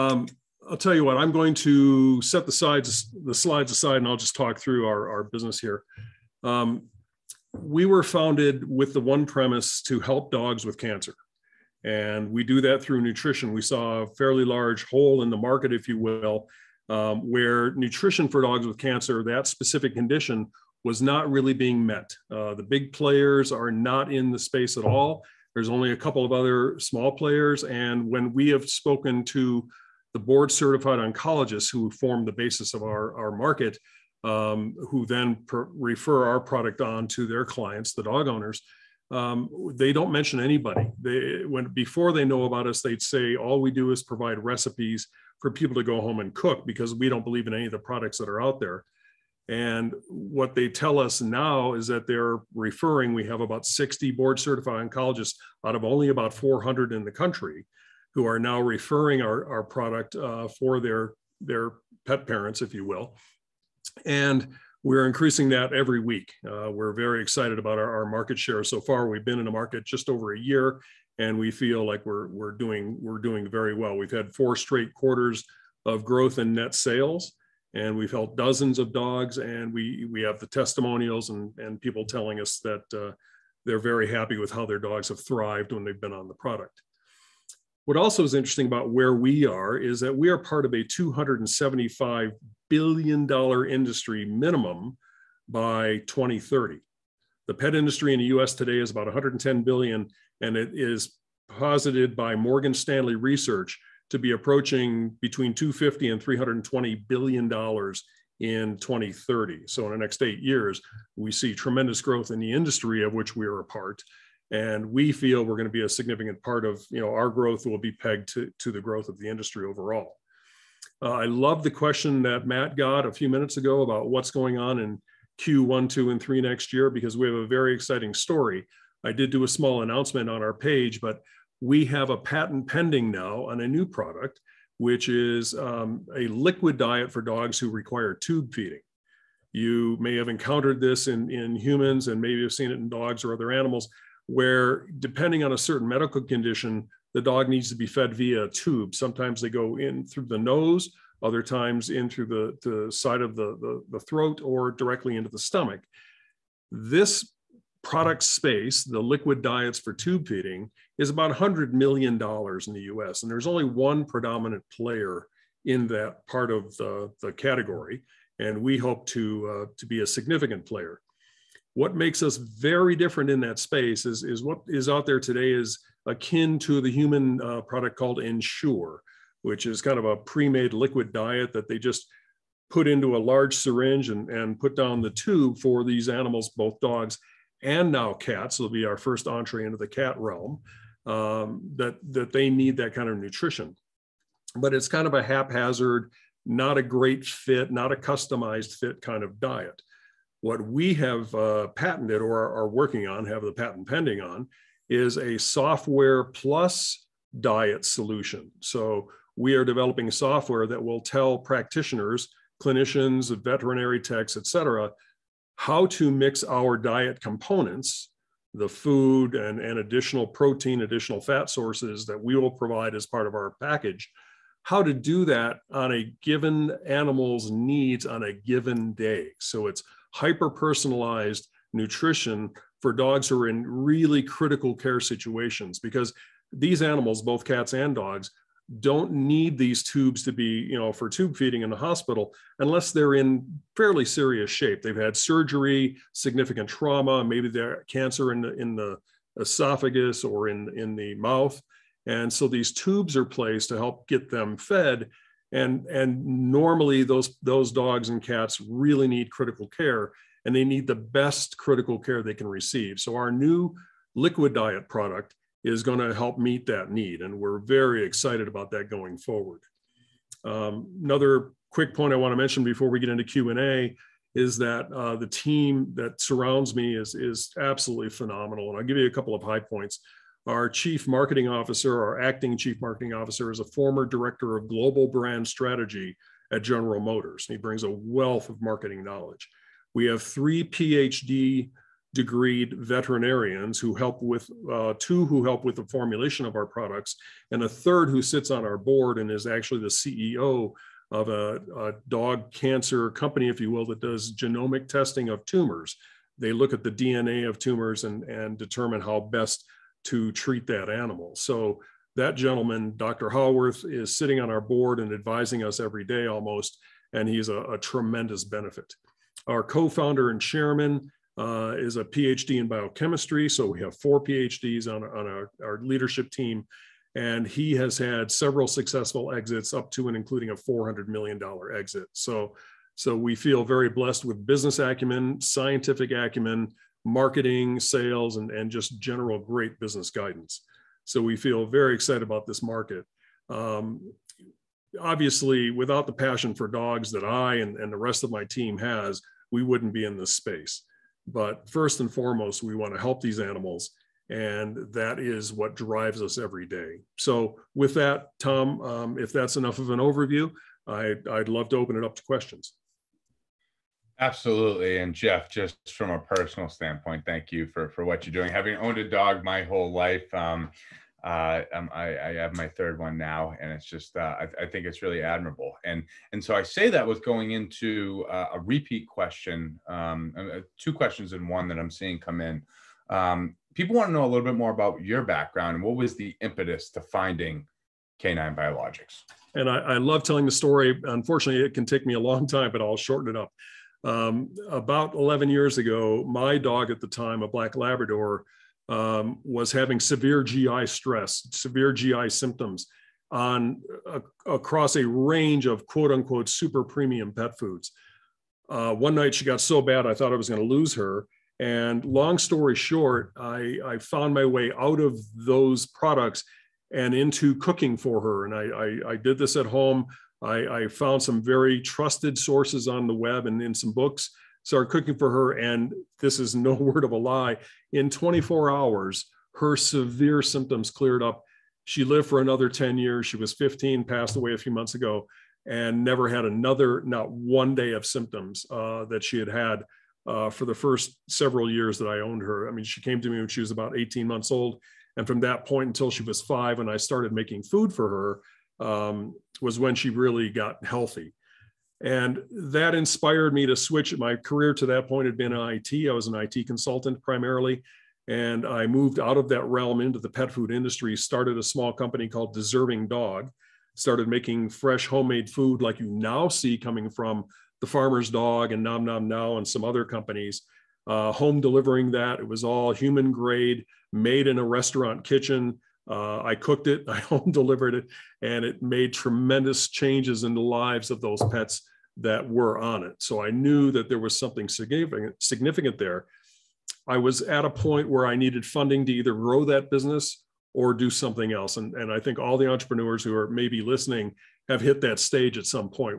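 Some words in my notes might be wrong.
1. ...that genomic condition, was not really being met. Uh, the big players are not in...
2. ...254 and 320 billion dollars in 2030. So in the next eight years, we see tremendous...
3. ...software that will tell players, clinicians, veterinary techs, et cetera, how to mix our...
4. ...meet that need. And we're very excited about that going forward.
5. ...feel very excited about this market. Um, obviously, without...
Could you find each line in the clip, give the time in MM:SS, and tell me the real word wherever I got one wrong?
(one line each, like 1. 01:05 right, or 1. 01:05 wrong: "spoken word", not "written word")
1. 00:19 wrong: "specific", not "genomic"
2. 01:45 wrong: "250", not "254"
3. 03:30 wrong: "practitioners", not "players"
4. 04:26 right
5. 05:41 right.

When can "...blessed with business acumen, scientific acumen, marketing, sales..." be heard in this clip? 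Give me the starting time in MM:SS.
05:33.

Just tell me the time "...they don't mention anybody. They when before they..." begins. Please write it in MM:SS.
00:39.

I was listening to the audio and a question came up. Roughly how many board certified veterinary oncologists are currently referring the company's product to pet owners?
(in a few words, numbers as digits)
60.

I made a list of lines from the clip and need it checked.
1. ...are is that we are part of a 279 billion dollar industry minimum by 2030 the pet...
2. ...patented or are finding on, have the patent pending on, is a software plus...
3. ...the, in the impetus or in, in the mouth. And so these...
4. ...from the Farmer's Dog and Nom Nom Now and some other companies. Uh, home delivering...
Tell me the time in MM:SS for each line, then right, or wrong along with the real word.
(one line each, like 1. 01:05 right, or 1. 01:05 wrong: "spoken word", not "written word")
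1. 01:29 wrong: "275", not "279"
2. 03:21 wrong: "working", not "finding"
3. 04:08 wrong: "esophagus", not "impetus"
4. 07:47 right.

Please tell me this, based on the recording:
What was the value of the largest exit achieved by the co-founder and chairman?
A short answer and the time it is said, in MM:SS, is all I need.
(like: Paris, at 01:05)
$400 million, at 05:30.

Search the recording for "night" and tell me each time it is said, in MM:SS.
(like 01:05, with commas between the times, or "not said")
06:49.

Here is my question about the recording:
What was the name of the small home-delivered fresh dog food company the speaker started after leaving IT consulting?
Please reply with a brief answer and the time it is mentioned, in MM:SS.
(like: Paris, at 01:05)
Deserving Dog, at 07:42.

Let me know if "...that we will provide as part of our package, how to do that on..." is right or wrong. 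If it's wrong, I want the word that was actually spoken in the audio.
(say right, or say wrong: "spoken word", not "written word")
right.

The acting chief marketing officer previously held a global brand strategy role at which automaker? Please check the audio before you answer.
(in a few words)
General Motors.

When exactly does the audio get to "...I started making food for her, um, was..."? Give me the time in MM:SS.
07:26.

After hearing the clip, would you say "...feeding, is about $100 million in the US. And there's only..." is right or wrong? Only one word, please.
right.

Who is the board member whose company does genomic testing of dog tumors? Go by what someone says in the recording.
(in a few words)
Dr. Howarth.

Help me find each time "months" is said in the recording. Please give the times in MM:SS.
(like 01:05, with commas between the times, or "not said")
07:14, 07:24.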